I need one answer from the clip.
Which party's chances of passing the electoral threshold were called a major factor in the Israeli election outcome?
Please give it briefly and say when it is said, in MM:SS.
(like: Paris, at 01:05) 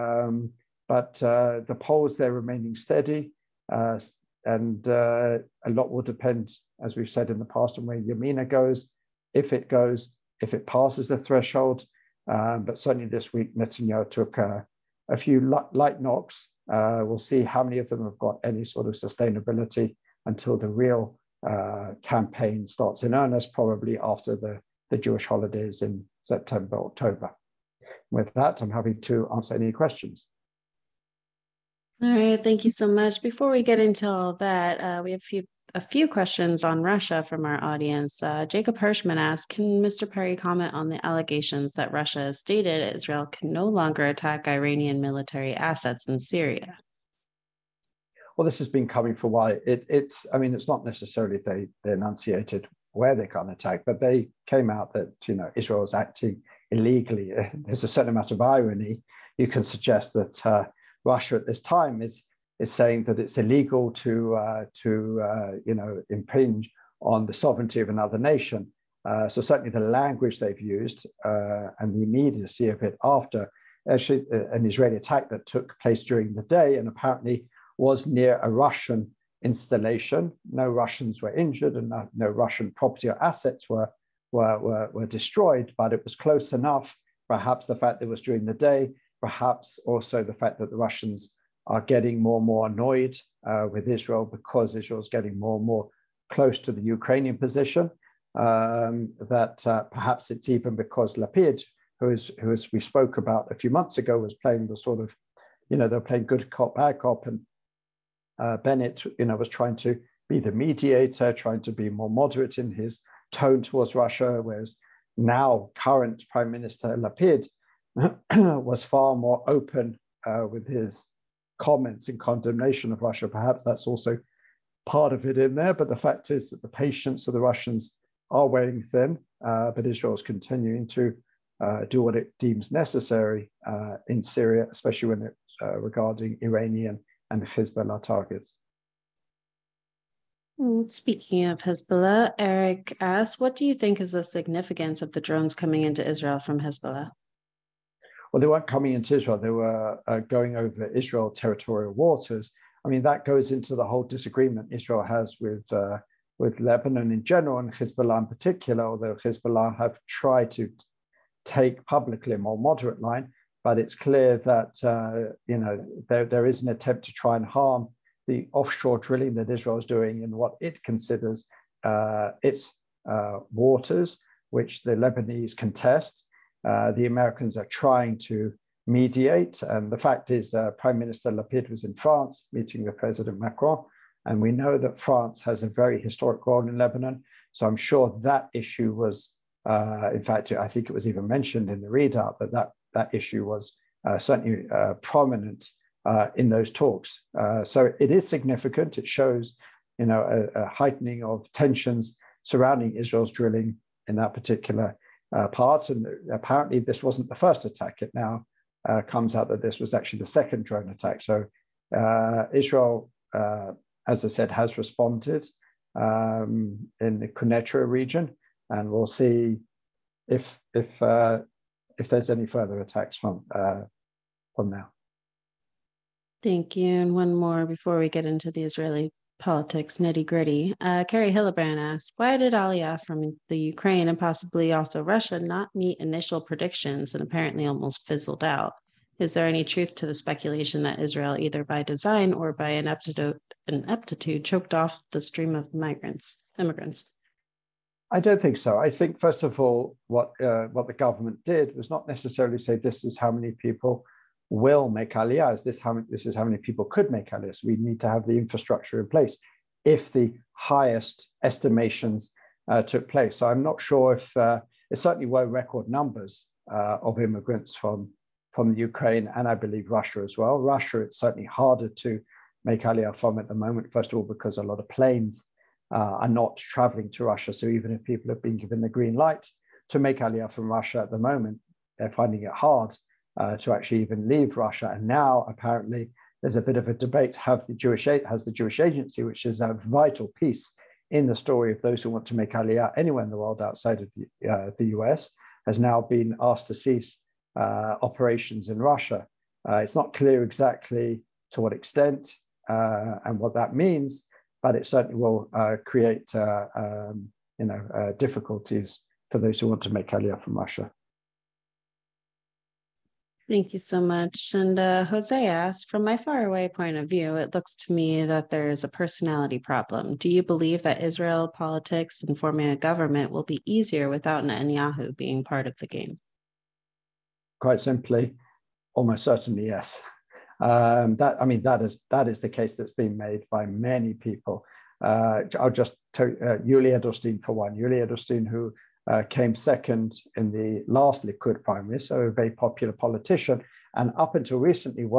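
Yamina, at 00:07.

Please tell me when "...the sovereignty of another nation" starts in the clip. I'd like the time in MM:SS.
01:07.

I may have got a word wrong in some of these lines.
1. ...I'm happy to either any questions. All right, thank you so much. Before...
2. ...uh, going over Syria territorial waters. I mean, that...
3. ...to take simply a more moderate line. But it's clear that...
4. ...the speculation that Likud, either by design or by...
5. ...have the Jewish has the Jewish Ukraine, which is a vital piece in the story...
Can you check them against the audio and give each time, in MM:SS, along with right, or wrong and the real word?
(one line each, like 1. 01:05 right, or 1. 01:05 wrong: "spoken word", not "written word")
1. 00:28 wrong: "answer", not "either"
2. 02:30 wrong: "Israel", not "Syria"
3. 02:40 wrong: "publicly", not "simply"
4. 04:00 wrong: "Israel", not "Likud"
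5. 04:47 wrong: "Agency", not "Ukraine".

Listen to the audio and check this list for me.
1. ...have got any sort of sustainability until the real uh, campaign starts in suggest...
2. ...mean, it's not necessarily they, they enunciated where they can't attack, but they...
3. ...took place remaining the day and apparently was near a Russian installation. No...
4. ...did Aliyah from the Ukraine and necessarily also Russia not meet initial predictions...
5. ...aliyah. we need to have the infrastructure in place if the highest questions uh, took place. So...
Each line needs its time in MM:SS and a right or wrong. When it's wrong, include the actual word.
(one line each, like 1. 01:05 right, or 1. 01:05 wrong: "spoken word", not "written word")
1. 00:18 wrong: "earnest", not "suggest"
2. 00:50 right
3. 01:15 wrong: "during", not "remaining"
4. 03:52 wrong: "possibly", not "necessarily"
5. 04:17 wrong: "estimations", not "questions".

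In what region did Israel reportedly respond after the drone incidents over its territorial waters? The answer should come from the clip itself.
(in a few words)
Quneitra.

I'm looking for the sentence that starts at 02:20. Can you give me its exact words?
Speaking of Hezbollah, Eric asks, what do you think is the significance of the drones coming into Israel from Hezbollah?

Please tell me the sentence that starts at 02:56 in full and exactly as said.
Uh, the Americans are trying to mediate.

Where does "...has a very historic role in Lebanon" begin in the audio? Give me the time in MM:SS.
03:05.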